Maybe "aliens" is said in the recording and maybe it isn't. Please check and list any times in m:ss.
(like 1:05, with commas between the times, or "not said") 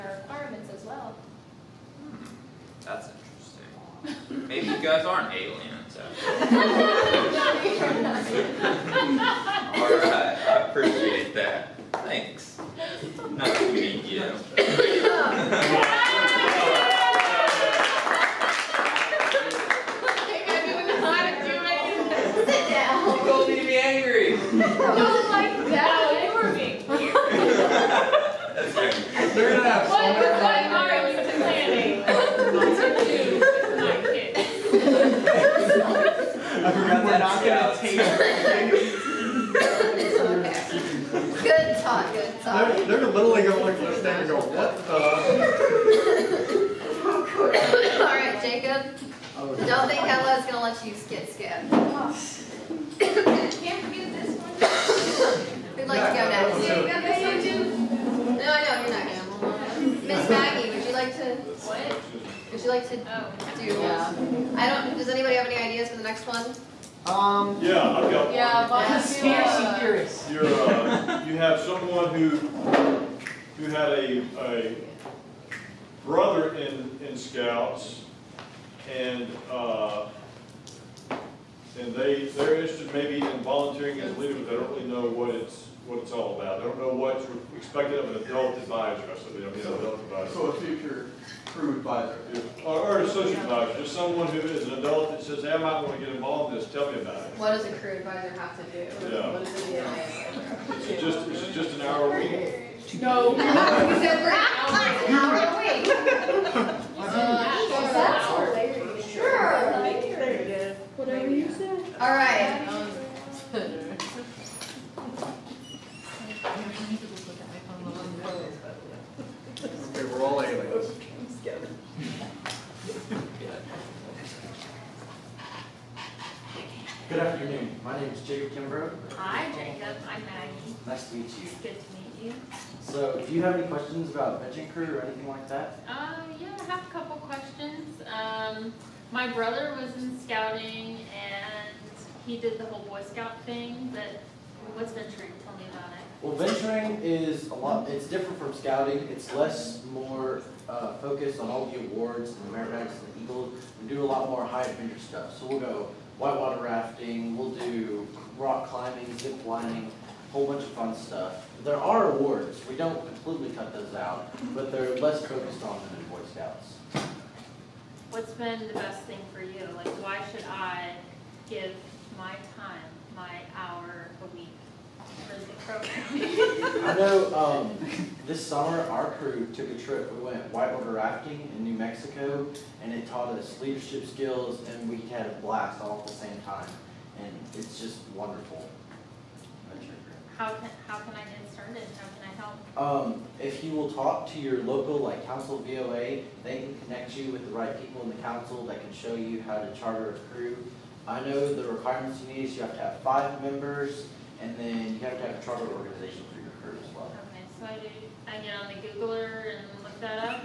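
0:05, 2:00.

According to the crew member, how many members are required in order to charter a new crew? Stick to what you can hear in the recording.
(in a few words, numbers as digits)
5.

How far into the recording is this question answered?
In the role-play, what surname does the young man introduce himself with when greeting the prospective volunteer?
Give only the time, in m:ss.
2:08.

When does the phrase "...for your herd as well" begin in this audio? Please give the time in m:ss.
3:26.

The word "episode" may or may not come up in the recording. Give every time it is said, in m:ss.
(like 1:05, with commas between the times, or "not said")
not said.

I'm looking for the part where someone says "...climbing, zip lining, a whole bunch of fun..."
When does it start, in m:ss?
2:38.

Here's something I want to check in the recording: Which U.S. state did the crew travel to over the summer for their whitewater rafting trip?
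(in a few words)
New Mexico.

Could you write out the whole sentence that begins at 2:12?
So, do you have any questions about Venture Crew or anything like that?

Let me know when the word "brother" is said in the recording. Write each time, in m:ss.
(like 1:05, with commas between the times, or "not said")
1:16, 2:19.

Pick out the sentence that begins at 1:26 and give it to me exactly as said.
They don't know what's expected of an adult advisor.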